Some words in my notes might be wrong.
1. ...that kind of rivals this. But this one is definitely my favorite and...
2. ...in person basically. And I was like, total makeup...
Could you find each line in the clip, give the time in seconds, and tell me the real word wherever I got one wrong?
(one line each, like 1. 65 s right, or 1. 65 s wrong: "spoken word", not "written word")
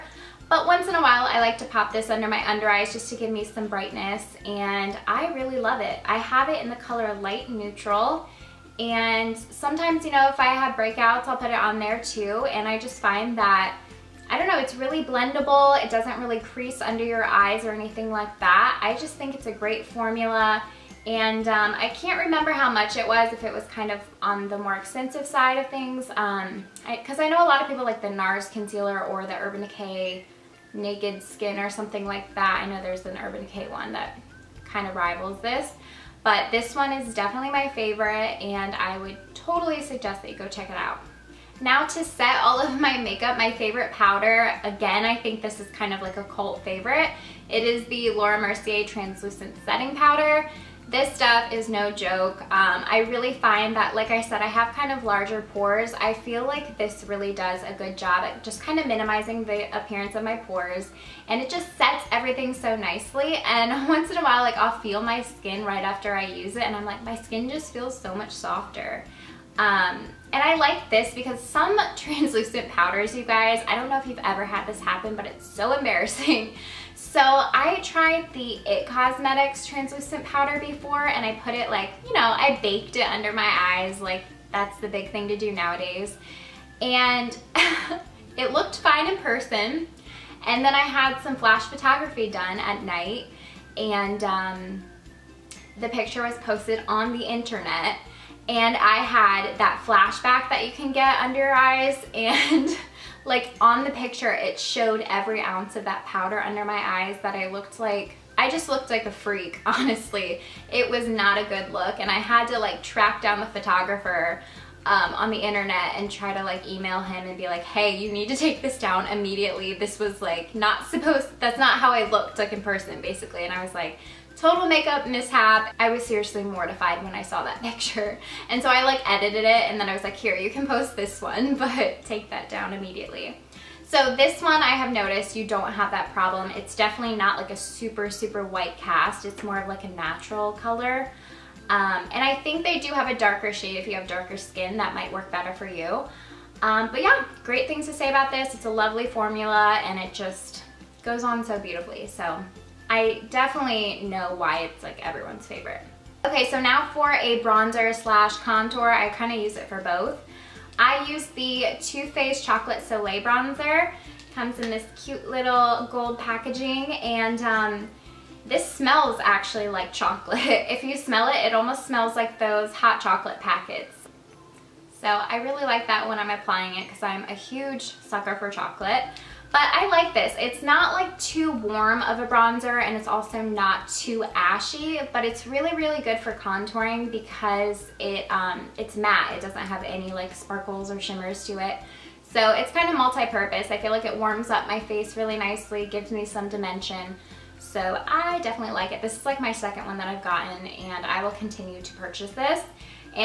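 1. 33 s right
2. 122 s right.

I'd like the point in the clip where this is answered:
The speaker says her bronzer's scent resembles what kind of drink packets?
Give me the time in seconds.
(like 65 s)
172 s.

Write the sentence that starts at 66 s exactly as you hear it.
And I'm like, my skin just feels so much softer.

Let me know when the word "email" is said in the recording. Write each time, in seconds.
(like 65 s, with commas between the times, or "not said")
116 s.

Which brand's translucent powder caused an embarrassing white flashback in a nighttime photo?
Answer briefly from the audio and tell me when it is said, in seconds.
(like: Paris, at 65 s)
IT Cosmetics, at 78 s.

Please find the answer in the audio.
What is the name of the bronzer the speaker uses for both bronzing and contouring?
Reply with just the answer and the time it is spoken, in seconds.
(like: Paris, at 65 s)
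Too Faced Chocolate Soleil, at 161 s.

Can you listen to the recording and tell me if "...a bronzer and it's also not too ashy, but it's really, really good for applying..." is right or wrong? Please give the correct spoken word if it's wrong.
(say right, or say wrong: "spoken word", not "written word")
wrong: "contouring", not "applying".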